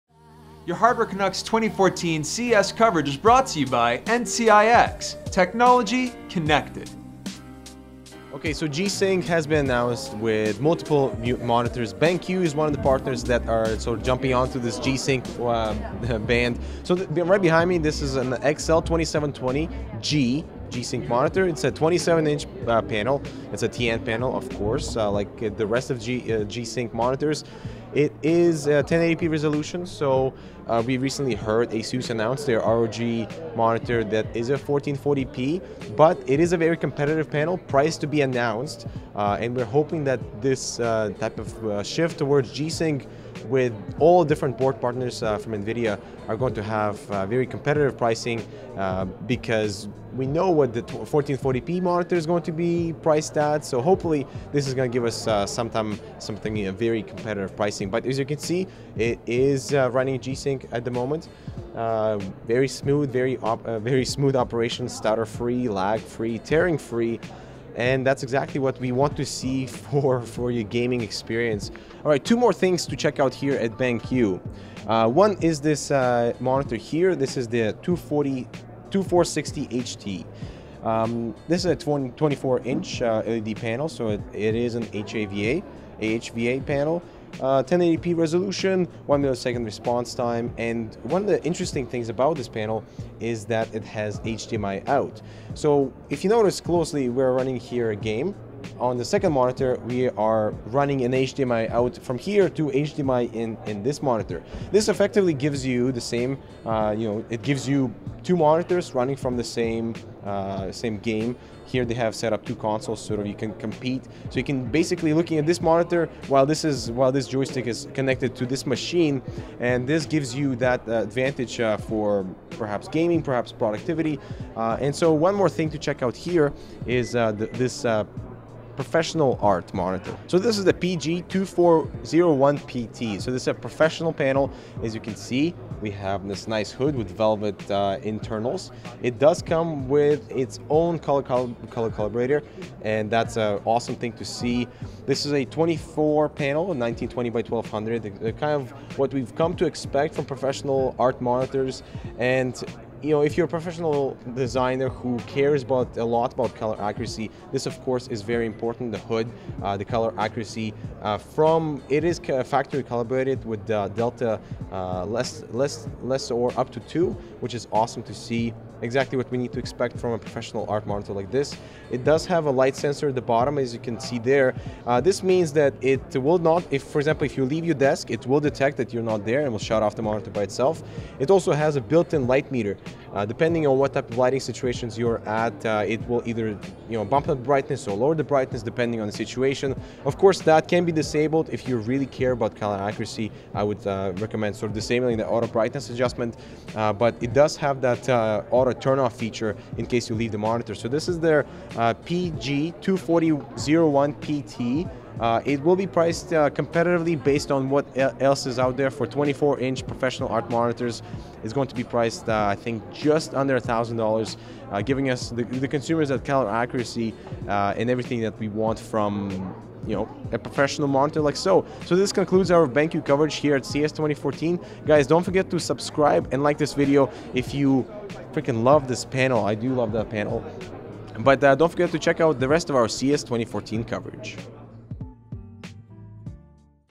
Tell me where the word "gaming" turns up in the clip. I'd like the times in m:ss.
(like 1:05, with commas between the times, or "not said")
1:10, 2:02.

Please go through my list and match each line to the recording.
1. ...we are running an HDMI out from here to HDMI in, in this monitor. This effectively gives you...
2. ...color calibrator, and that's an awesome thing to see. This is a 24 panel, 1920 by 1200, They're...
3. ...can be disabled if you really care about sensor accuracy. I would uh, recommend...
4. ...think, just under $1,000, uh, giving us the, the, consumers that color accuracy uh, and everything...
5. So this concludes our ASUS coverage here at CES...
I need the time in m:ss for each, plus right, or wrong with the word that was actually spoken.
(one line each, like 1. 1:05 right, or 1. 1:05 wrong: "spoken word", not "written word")
1. 1:39 right
2. 2:21 right
3. 3:10 wrong: "color", not "sensor"
4. 3:32 right
5. 3:41 wrong: "BenQ", not "ASUS".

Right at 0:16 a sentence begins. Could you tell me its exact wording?
So right behind me, this is an XL2720G G-Sync monitor.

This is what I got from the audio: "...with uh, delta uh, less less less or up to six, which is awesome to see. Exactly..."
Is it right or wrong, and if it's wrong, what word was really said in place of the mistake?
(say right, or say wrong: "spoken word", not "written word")
wrong: "two", not "six".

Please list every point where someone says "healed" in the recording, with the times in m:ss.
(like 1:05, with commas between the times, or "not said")
not said.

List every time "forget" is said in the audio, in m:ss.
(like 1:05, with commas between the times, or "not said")
3:45, 3:51.